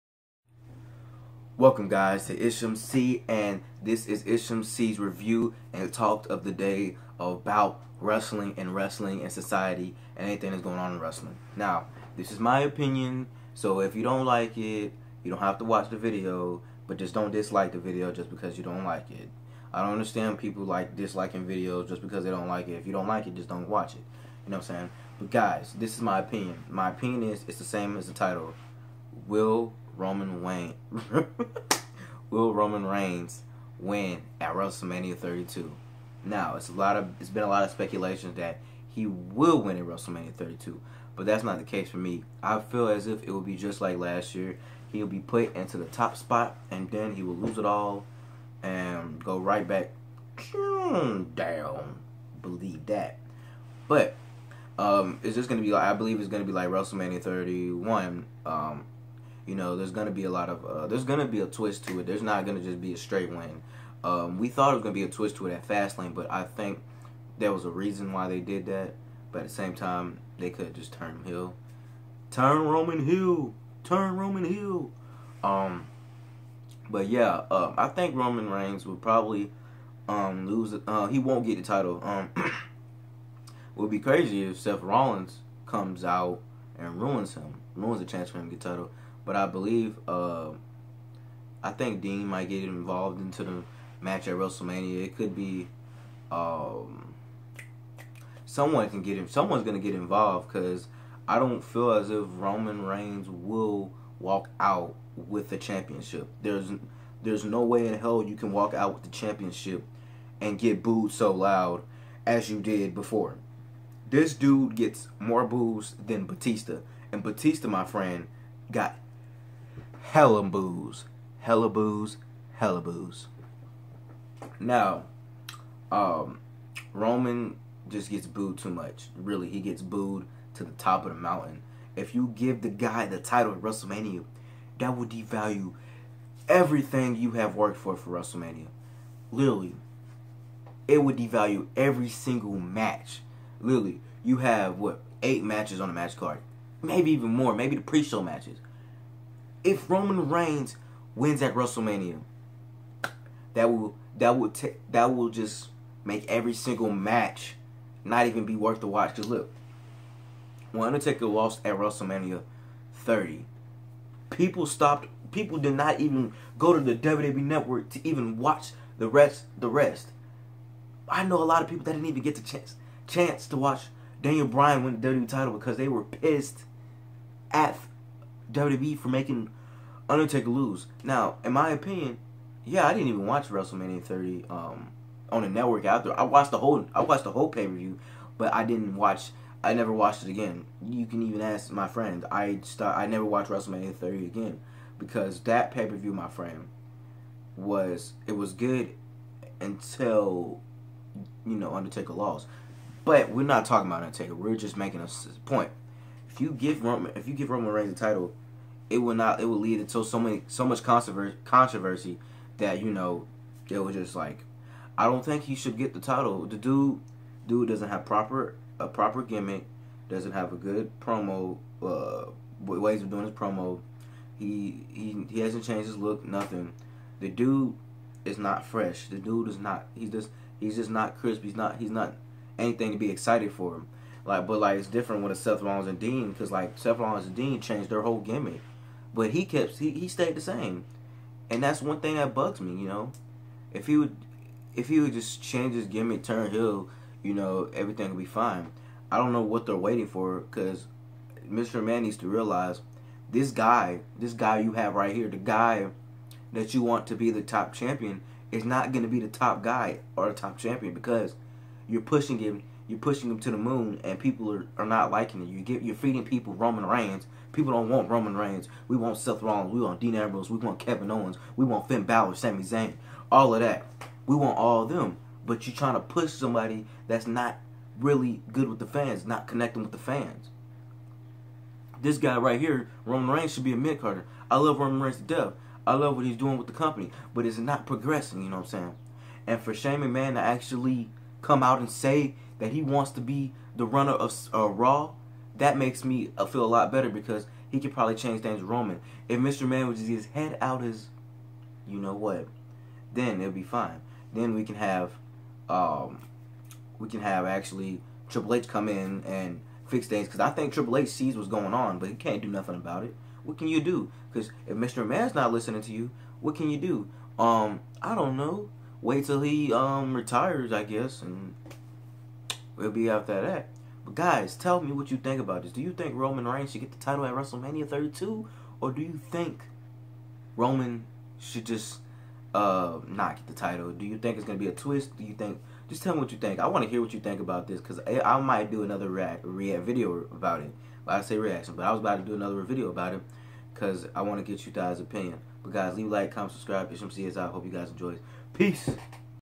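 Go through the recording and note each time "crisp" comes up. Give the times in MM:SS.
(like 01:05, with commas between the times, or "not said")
03:51.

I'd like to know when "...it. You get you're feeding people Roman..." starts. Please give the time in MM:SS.
04:25.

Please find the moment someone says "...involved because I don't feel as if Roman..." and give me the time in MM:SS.
01:39.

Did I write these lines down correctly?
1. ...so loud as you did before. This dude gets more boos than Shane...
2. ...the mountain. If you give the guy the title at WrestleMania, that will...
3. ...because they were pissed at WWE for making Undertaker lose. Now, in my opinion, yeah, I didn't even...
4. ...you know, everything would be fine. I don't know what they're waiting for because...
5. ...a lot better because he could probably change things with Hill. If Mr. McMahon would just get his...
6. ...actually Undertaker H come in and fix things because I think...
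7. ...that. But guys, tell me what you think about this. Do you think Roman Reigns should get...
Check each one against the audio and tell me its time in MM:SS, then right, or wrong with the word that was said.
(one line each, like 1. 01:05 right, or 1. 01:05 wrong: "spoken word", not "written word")
1. 01:51 wrong: "Batista", not "Shane"
2. 02:11 right
3. 02:55 right
4. 04:07 right
5. 04:56 wrong: "Roman", not "Hill"
6. 05:07 wrong: "Triple", not "Undertaker"
7. 05:23 right.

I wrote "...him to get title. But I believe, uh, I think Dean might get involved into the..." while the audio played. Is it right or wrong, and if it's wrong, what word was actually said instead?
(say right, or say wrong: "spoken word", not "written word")
right.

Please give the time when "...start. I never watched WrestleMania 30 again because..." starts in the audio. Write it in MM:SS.
03:12.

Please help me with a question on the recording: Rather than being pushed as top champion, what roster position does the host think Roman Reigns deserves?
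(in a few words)
mid carder.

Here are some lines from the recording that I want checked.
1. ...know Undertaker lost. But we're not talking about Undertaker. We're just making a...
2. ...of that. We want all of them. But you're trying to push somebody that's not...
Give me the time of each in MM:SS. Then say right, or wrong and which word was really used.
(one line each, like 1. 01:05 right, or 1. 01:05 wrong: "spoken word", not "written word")
1. 03:21 right
2. 04:33 right.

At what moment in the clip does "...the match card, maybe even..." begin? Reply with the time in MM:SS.
02:25.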